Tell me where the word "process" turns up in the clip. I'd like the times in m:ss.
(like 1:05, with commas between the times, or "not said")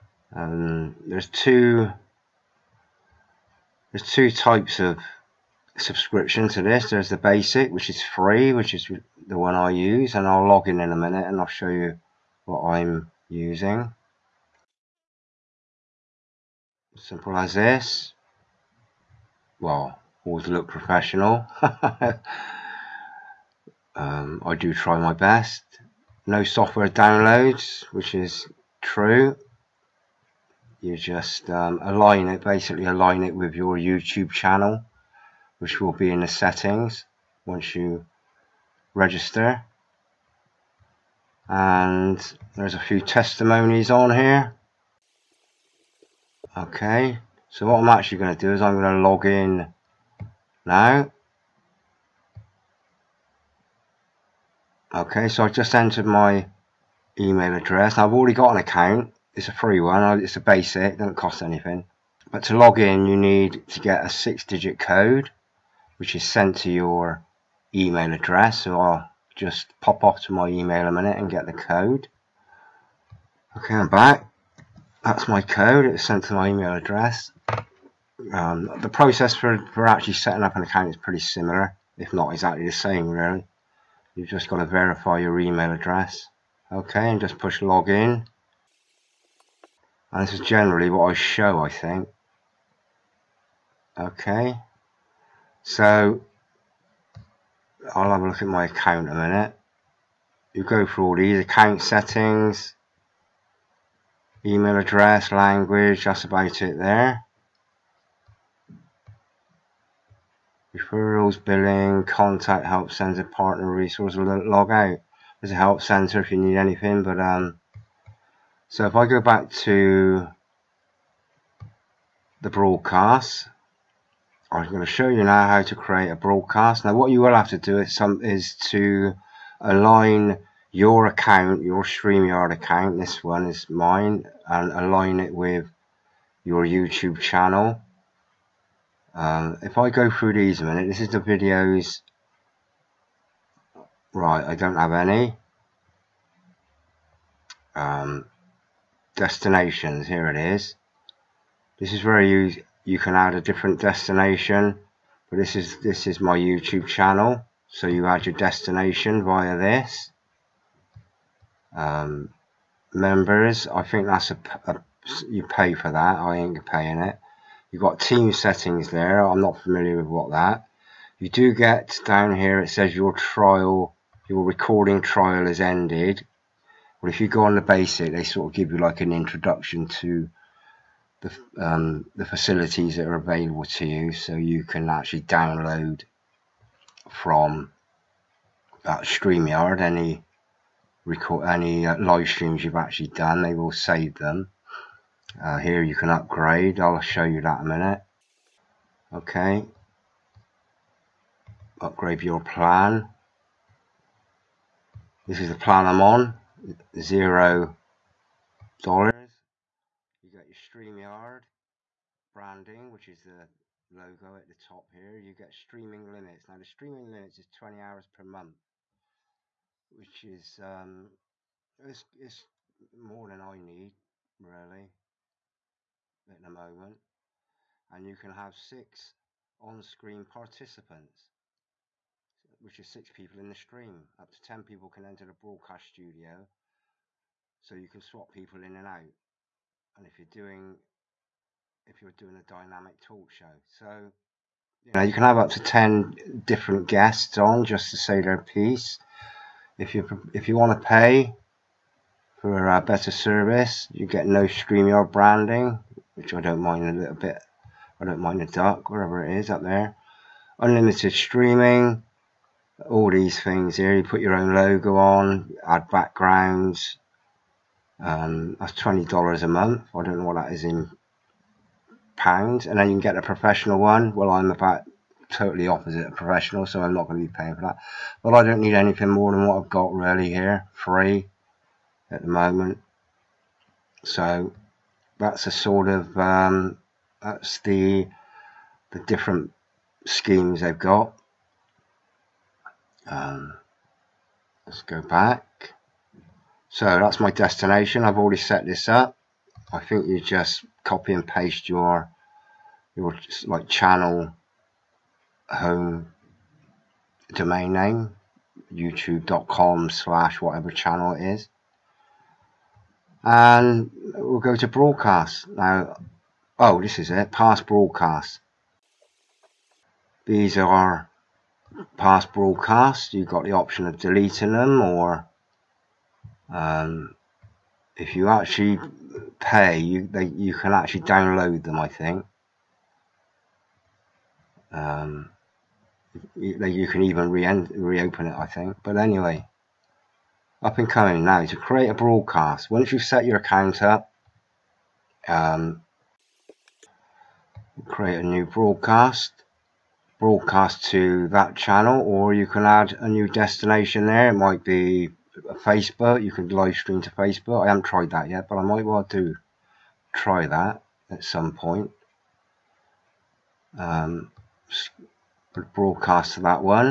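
1:18.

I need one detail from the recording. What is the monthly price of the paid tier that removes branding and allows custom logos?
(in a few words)
$20.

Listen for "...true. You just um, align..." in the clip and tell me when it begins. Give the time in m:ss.
0:28.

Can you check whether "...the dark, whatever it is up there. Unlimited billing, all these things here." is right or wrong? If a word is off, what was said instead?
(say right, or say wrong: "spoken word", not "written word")
wrong: "streaming", not "billing".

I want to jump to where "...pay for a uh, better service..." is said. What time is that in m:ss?
4:10.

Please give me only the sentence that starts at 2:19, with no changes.
Um, if I go through these a minute, this is the videos.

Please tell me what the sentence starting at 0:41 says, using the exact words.
And there's a few testimonies on here.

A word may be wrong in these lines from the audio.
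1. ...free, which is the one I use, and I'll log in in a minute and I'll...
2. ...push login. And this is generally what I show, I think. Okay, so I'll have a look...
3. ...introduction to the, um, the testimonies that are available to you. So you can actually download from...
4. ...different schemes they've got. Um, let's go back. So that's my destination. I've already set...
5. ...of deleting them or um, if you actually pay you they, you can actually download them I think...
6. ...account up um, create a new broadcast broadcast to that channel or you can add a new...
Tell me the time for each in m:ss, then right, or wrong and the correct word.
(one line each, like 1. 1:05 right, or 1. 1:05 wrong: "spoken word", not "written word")
1. 0:08 right
2. 1:27 right
3. 2:59 wrong: "facilities", not "testimonies"
4. 4:49 right
5. 5:23 right
6. 5:43 right.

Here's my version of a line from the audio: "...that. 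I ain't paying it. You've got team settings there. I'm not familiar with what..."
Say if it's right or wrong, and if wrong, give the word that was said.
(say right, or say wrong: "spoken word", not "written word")
right.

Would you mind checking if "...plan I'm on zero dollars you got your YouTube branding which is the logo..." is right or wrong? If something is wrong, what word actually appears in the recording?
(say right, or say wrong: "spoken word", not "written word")
wrong: "StreamYard", not "YouTube".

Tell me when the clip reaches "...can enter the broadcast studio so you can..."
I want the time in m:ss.
3:54.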